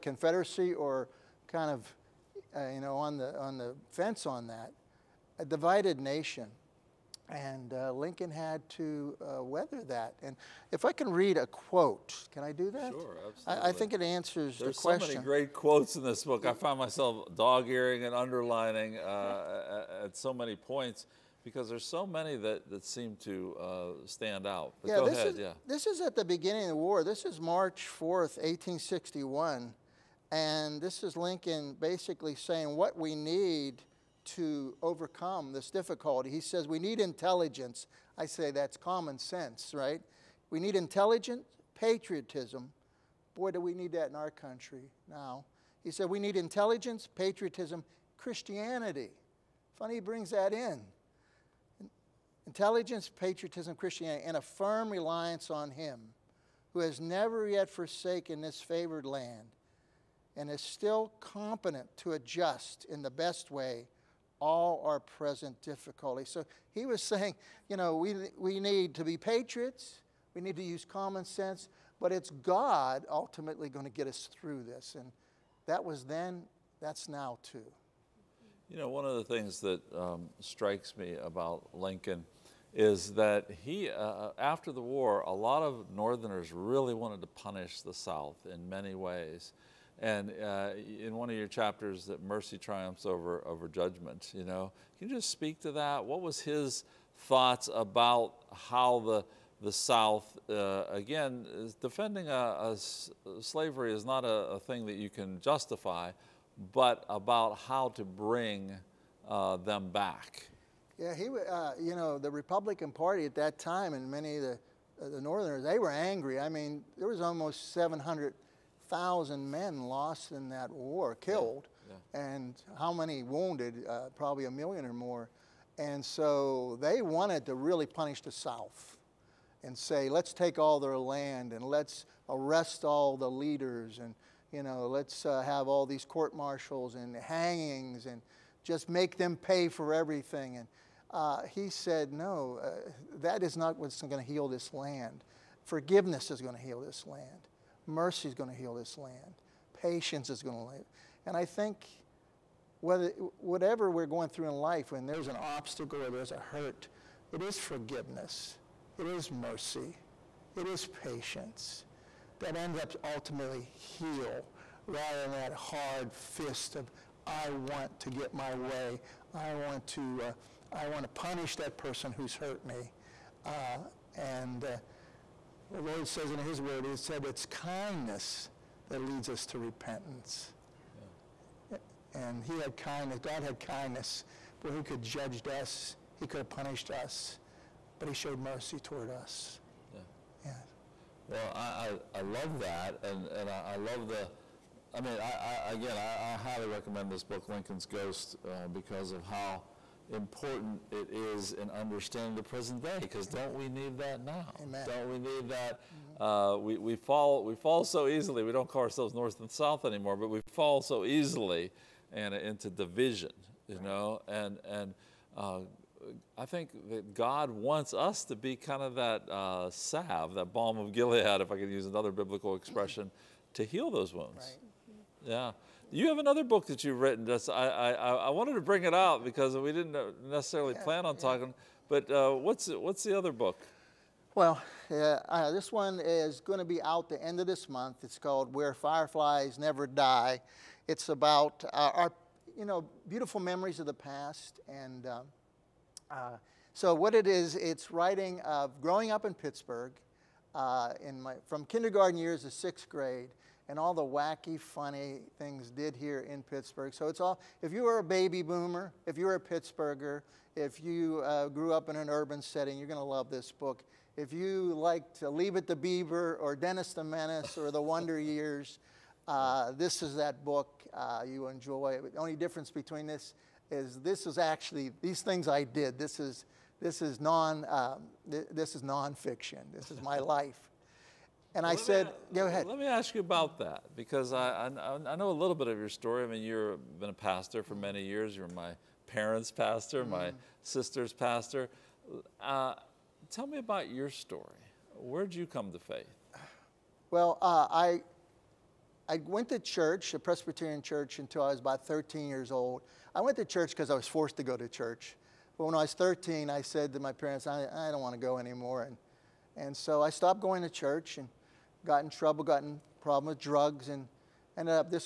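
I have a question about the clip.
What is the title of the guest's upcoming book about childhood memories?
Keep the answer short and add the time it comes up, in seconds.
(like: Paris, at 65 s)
Where Fireflies Never Die, at 238 s.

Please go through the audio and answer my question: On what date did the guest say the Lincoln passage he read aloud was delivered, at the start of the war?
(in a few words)
March 4th, 1861.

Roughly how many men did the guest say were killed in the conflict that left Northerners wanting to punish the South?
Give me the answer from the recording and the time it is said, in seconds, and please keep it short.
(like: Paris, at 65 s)
700,000, at 117 s.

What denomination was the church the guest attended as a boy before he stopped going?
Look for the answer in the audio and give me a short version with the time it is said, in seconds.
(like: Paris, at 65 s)
Presbyterian, at 300 s.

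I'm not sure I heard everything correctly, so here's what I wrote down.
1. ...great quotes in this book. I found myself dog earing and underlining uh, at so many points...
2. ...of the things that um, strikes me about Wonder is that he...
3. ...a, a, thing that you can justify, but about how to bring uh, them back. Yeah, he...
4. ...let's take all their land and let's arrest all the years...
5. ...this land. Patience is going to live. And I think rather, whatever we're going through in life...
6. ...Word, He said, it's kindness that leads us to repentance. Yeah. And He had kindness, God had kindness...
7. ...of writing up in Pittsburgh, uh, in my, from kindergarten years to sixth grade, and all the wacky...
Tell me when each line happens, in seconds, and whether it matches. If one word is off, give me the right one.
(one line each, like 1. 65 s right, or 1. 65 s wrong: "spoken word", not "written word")
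1. 15 s right
2. 79 s wrong: "Lincoln", not "Wonder"
3. 104 s right
4. 130 s wrong: "leaders", not "years"
5. 148 s wrong: "whether", not "rather"
6. 176 s right
7. 248 s wrong: "growing", not "writing".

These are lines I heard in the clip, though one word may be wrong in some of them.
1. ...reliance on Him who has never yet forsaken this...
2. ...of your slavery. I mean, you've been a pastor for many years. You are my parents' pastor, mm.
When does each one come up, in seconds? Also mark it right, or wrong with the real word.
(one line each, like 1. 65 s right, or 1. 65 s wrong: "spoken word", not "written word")
1. 54 s right
2. 285 s wrong: "story", not "slavery".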